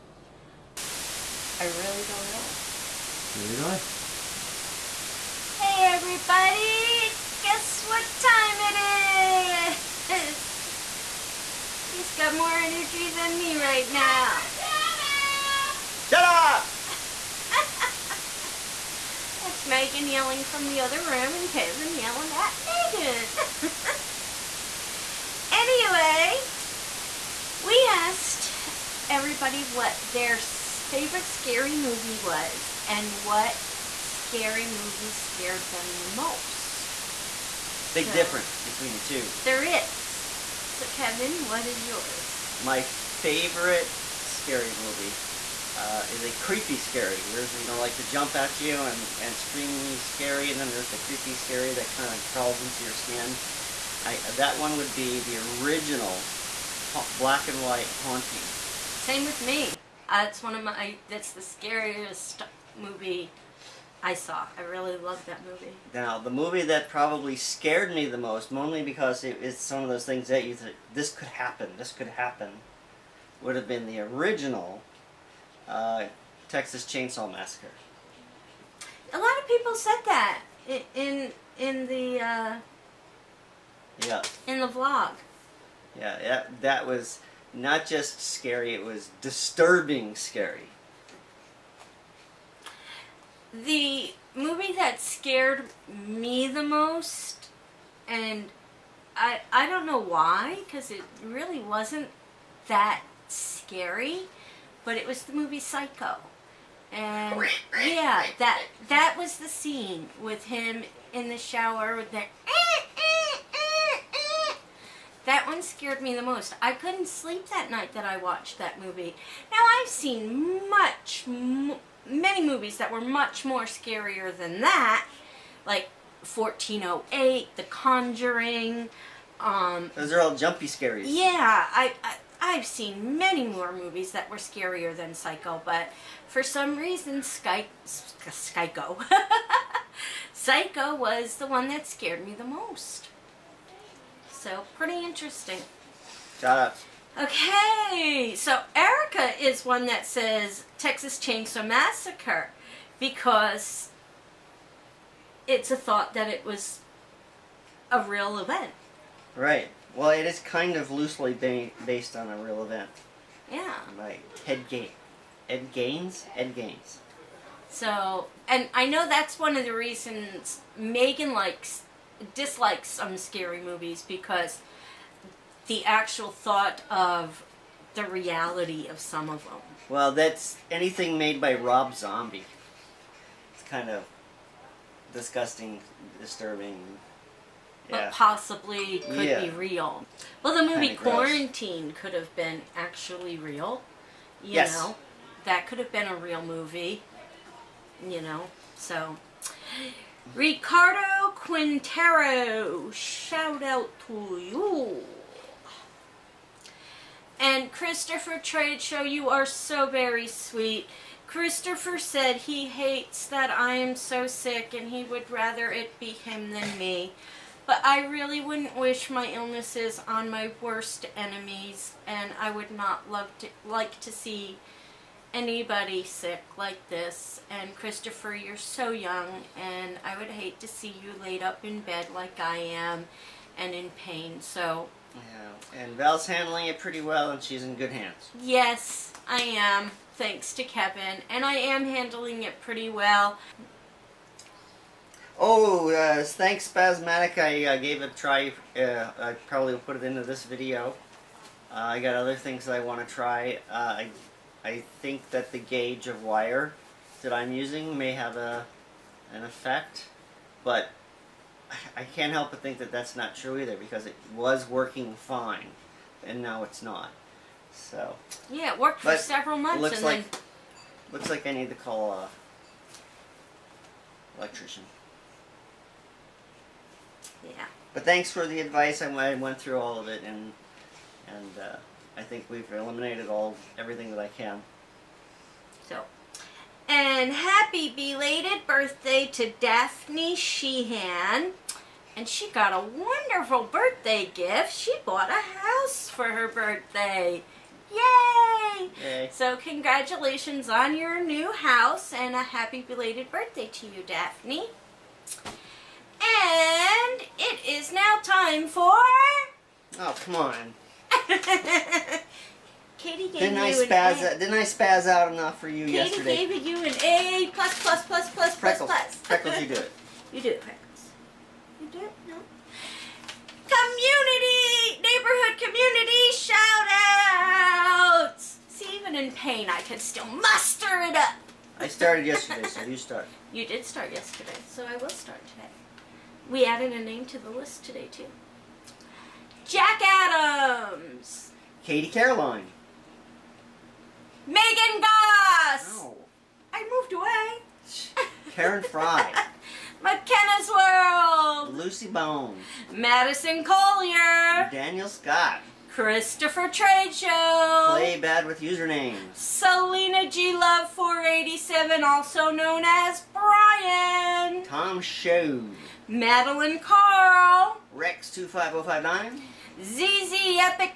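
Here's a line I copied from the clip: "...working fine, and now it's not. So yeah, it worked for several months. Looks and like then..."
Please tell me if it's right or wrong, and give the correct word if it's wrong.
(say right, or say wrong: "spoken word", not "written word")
right.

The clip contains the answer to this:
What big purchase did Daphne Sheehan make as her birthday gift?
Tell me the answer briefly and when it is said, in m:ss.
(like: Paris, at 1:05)
A house, at 4:55.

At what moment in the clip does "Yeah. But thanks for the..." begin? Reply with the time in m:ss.
4:37.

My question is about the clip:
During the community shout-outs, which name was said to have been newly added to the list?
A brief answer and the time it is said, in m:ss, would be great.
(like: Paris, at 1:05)
Jack Adams, at 5:39.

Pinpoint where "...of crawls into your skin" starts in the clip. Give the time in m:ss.
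0:52.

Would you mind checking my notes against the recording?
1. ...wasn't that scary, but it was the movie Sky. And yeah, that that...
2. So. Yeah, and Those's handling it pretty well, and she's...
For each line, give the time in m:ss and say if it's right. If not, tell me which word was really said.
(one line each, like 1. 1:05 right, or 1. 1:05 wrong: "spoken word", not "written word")
1. 1:41 wrong: "Psycho", not "Sky"
2. 3:54 wrong: "Val", not "Those".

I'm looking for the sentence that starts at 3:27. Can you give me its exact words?
And Christopher Trade Show, you are so very sweet.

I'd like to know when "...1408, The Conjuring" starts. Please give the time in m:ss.
2:06.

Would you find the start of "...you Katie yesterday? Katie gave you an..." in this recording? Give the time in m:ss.
5:15.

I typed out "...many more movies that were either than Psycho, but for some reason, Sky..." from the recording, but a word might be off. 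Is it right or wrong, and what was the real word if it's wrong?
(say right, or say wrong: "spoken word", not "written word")
wrong: "scarier", not "either".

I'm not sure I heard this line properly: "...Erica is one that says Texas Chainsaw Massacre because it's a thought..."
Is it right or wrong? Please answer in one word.
right.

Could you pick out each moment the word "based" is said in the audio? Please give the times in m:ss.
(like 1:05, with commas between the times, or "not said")
2:41.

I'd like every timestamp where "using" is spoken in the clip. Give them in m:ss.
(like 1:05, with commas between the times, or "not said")
4:17.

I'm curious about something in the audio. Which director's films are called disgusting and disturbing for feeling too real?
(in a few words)
Rob Zombie.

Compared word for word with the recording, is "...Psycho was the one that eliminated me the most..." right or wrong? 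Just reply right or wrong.
wrong.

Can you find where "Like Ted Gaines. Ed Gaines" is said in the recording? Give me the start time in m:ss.
2:43.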